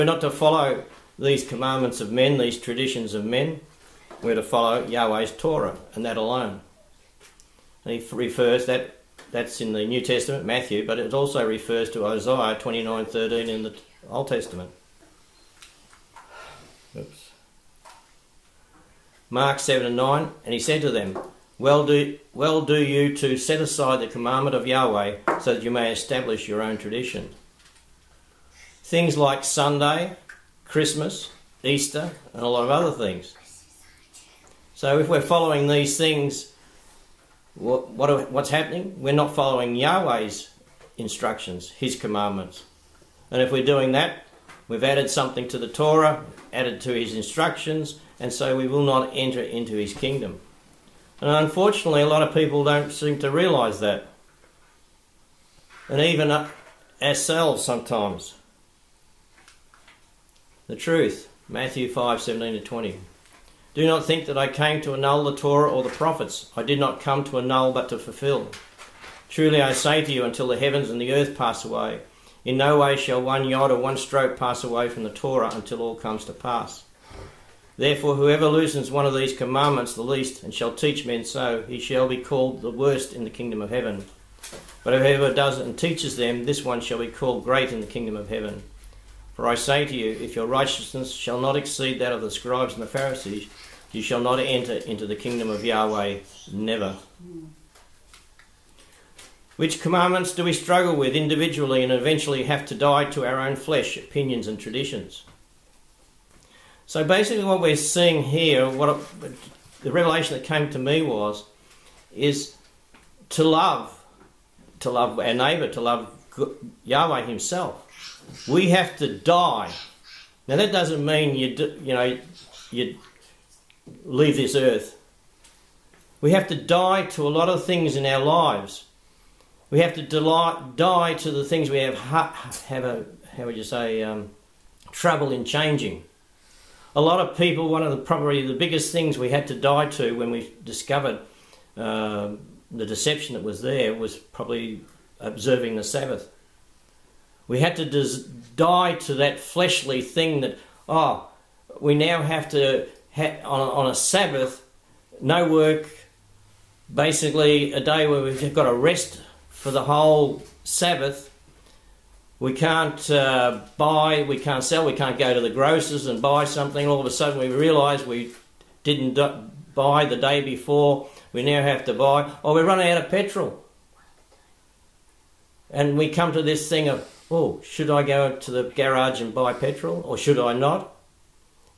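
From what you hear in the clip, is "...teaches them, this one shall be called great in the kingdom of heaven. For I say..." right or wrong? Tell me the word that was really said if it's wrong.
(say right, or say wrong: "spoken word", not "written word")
right.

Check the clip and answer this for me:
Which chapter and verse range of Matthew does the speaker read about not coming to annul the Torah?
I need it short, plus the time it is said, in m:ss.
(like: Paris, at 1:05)
Matthew 5:17-20, at 1:01.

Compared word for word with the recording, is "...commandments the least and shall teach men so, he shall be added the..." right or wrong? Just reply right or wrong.
wrong.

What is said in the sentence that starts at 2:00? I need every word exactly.
Now that doesn't mean you do, you know you leave this earth.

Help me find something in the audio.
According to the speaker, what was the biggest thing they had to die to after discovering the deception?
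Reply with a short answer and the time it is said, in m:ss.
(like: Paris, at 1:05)
Observing the Sabbath, at 2:25.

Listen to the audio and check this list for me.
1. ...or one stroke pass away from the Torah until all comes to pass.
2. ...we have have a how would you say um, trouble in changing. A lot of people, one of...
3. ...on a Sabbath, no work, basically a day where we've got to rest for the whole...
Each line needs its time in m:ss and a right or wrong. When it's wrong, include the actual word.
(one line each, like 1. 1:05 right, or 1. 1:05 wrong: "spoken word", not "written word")
1. 1:13 right
2. 2:11 right
3. 2:33 right.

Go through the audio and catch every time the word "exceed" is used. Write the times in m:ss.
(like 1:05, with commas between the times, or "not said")
1:31.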